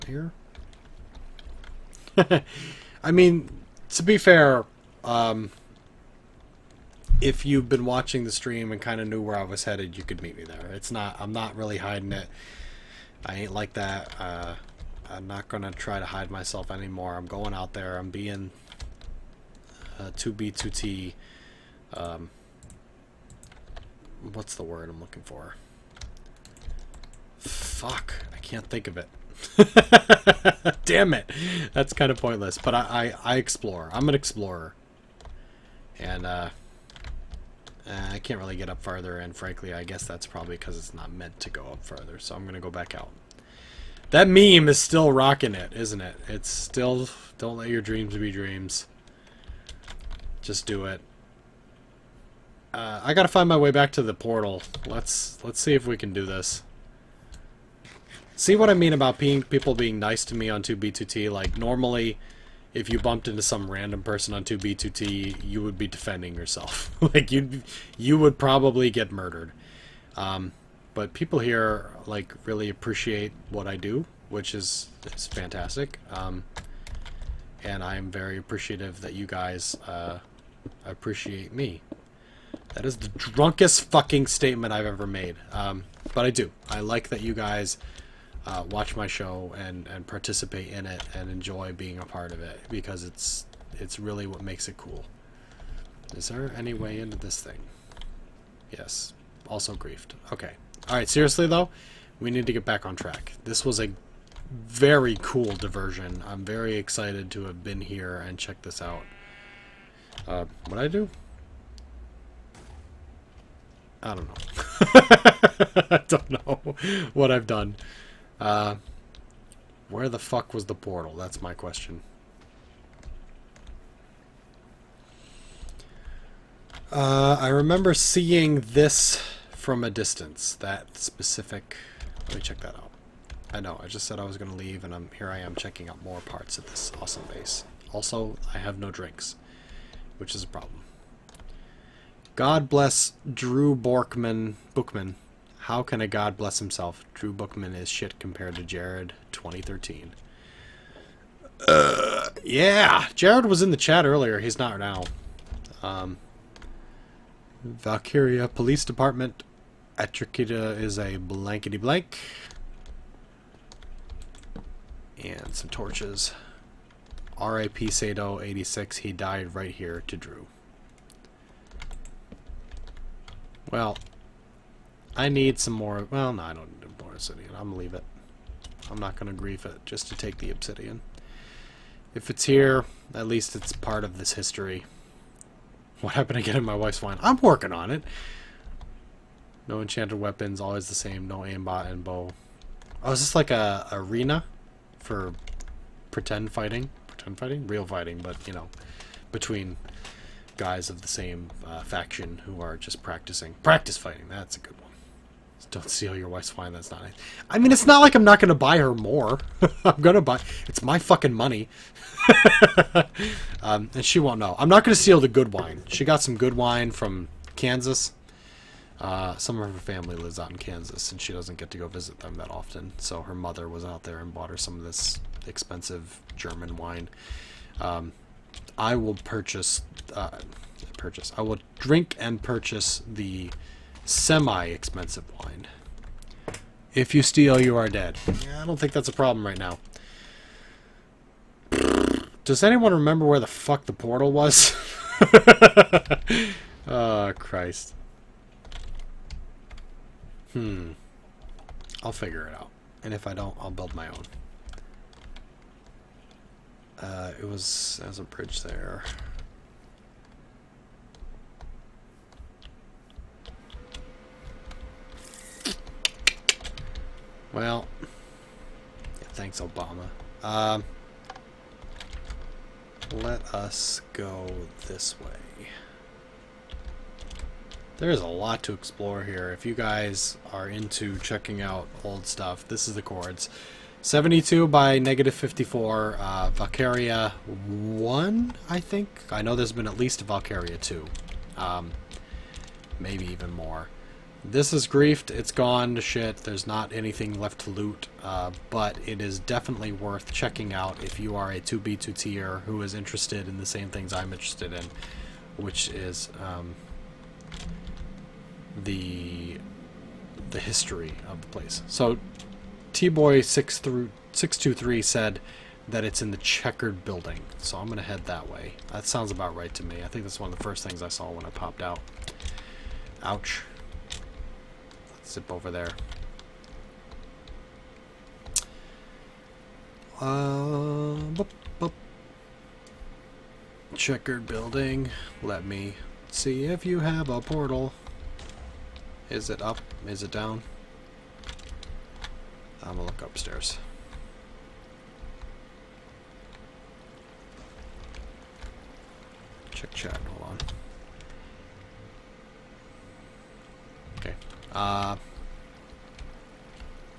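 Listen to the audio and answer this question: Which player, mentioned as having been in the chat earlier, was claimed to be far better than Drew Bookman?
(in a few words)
Jared 2013.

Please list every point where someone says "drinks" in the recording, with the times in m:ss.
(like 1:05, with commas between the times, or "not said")
2:18, 3:51.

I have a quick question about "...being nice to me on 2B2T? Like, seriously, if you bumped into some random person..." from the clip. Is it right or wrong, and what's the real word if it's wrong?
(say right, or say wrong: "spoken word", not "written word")
wrong: "normally", not "seriously".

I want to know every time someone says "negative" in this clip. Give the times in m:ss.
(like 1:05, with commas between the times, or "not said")
4:44.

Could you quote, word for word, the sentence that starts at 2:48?
He died right here to Drew.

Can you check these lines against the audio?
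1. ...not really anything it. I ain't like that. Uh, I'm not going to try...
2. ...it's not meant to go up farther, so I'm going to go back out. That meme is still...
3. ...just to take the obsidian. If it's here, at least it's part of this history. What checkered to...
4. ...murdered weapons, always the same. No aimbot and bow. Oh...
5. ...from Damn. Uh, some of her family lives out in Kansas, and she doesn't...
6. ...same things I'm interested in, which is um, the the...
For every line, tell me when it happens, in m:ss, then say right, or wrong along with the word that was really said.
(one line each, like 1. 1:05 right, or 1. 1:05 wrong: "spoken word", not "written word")
1. 0:11 wrong: "hiding", not "anything"
2. 0:40 right
3. 2:59 wrong: "happened", not "checkered"
4. 3:09 wrong: "enchanted", not "murdered"
5. 3:36 wrong: "Kansas", not "Damn"
6. 5:03 right.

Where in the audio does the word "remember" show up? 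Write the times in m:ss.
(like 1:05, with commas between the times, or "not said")
2:07, 4:02.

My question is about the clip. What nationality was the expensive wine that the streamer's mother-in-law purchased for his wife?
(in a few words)
German.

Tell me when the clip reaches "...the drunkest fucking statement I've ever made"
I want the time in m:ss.
1:22.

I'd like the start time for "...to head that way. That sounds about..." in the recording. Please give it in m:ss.
5:17.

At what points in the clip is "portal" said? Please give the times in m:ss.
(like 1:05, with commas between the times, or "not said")
0:54, 2:00, 4:03, 5:37.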